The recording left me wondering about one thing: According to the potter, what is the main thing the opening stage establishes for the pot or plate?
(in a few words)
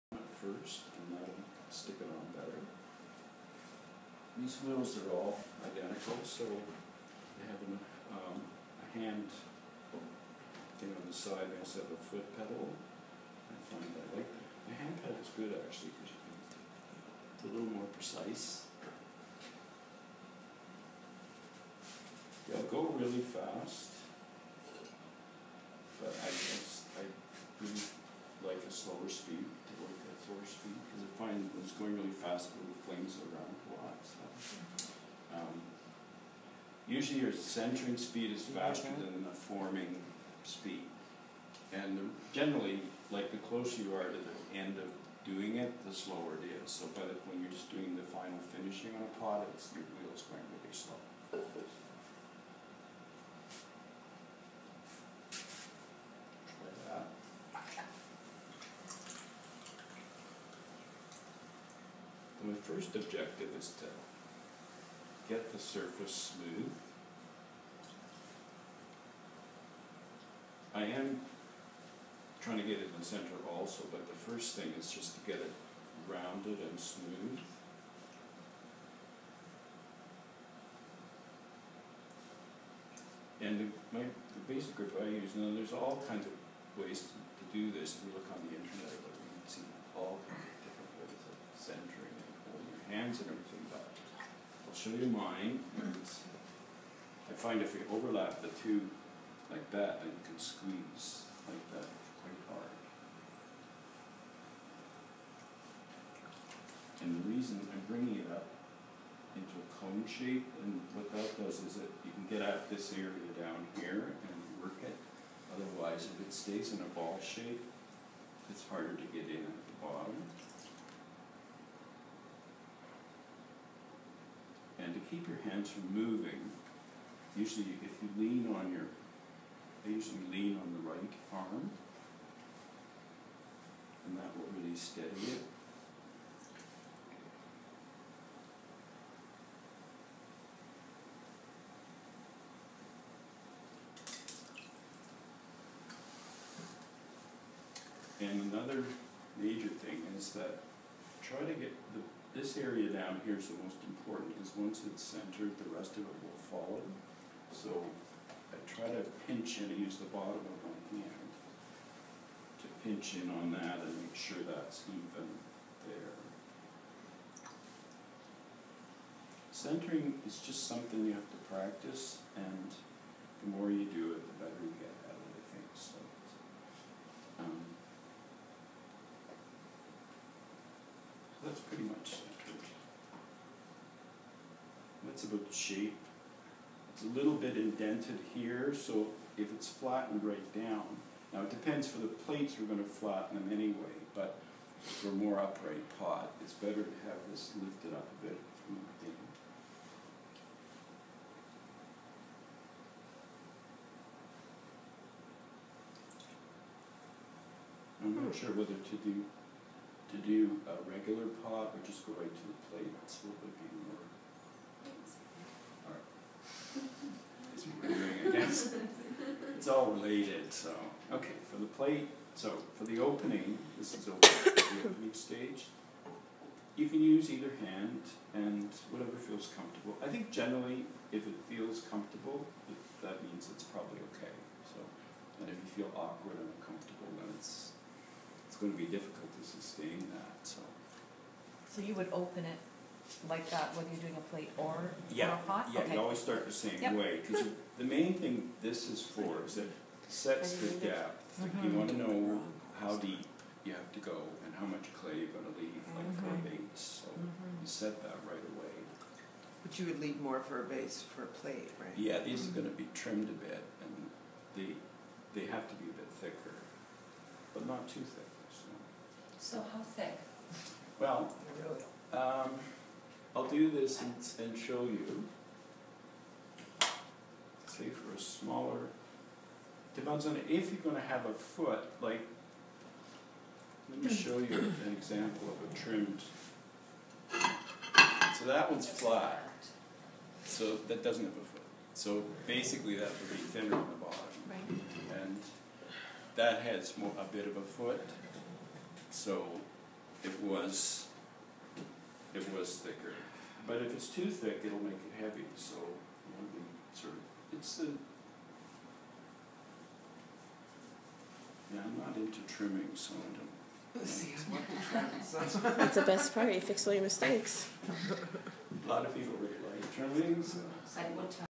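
the depth.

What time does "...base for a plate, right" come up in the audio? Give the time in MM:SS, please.
04:20.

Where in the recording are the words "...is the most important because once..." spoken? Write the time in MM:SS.
02:33.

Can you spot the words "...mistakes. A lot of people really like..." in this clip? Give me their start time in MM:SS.
05:17.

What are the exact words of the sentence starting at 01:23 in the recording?
And the, my, the basic grip I use, now there's all kinds of ways to, to do this.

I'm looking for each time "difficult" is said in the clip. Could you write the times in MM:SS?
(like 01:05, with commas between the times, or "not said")
03:58.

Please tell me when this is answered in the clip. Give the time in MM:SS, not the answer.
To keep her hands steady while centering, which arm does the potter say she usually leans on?
02:10.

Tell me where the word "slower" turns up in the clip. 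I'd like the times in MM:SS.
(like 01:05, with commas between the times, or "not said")
00:28, 00:45.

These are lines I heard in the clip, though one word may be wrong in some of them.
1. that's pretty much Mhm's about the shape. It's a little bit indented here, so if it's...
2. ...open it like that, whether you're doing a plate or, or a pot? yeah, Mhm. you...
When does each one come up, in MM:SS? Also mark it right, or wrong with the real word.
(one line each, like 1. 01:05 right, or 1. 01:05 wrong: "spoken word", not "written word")
1. 03:01 wrong: "That", not "Mhm"
2. 04:02 wrong: "Okay", not "Mhm".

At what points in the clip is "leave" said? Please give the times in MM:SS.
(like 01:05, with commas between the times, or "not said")
04:15, 04:19.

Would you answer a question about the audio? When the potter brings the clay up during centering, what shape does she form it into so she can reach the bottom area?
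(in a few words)
cone shape.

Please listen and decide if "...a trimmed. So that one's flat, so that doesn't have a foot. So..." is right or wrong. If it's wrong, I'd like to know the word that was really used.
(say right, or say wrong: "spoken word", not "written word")
right.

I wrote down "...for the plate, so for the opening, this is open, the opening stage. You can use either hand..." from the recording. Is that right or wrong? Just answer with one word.
right.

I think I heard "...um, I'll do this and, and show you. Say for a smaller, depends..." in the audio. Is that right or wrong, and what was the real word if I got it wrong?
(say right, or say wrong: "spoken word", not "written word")
right.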